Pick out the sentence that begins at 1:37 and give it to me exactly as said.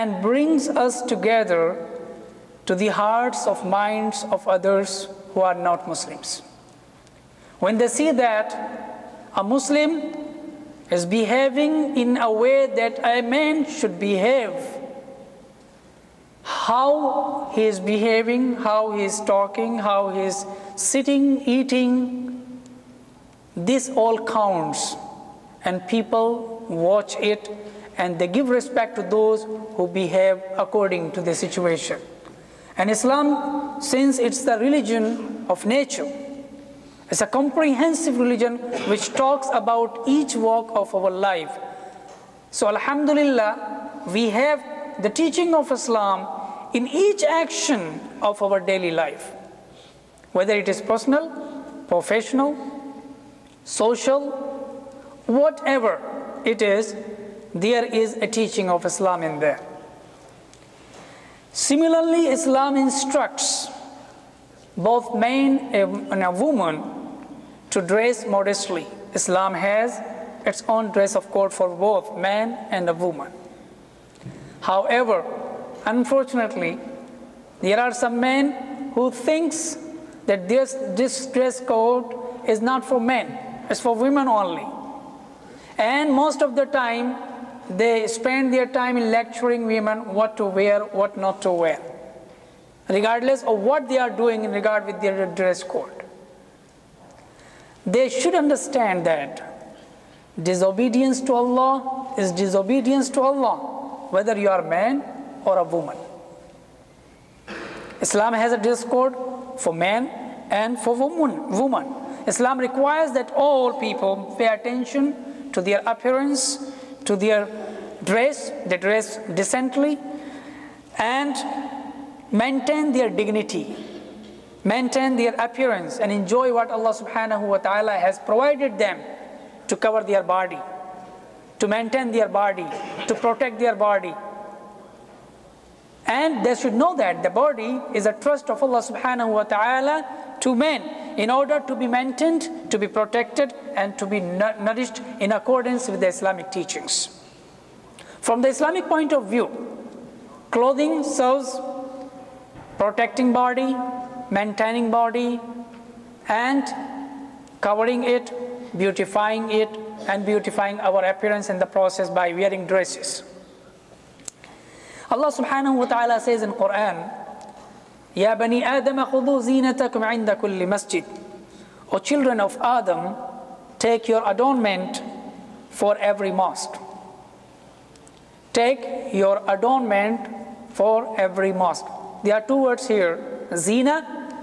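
They should understand that disobedience to Allah is disobedience to Allah, whether you are a man or a woman.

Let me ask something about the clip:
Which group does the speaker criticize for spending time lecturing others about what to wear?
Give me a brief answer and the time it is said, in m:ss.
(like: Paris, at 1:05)
some men, at 1:17.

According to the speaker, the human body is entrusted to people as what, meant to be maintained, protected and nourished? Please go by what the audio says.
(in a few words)
a trust of Allah.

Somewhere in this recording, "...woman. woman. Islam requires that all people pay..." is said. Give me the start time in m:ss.
1:50.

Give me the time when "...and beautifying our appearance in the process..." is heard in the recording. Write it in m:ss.
2:40.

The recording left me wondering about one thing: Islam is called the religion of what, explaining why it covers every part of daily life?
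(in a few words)
nature.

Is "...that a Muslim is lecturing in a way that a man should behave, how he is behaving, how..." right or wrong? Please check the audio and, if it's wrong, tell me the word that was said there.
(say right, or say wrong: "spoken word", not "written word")
wrong: "behaving", not "lecturing".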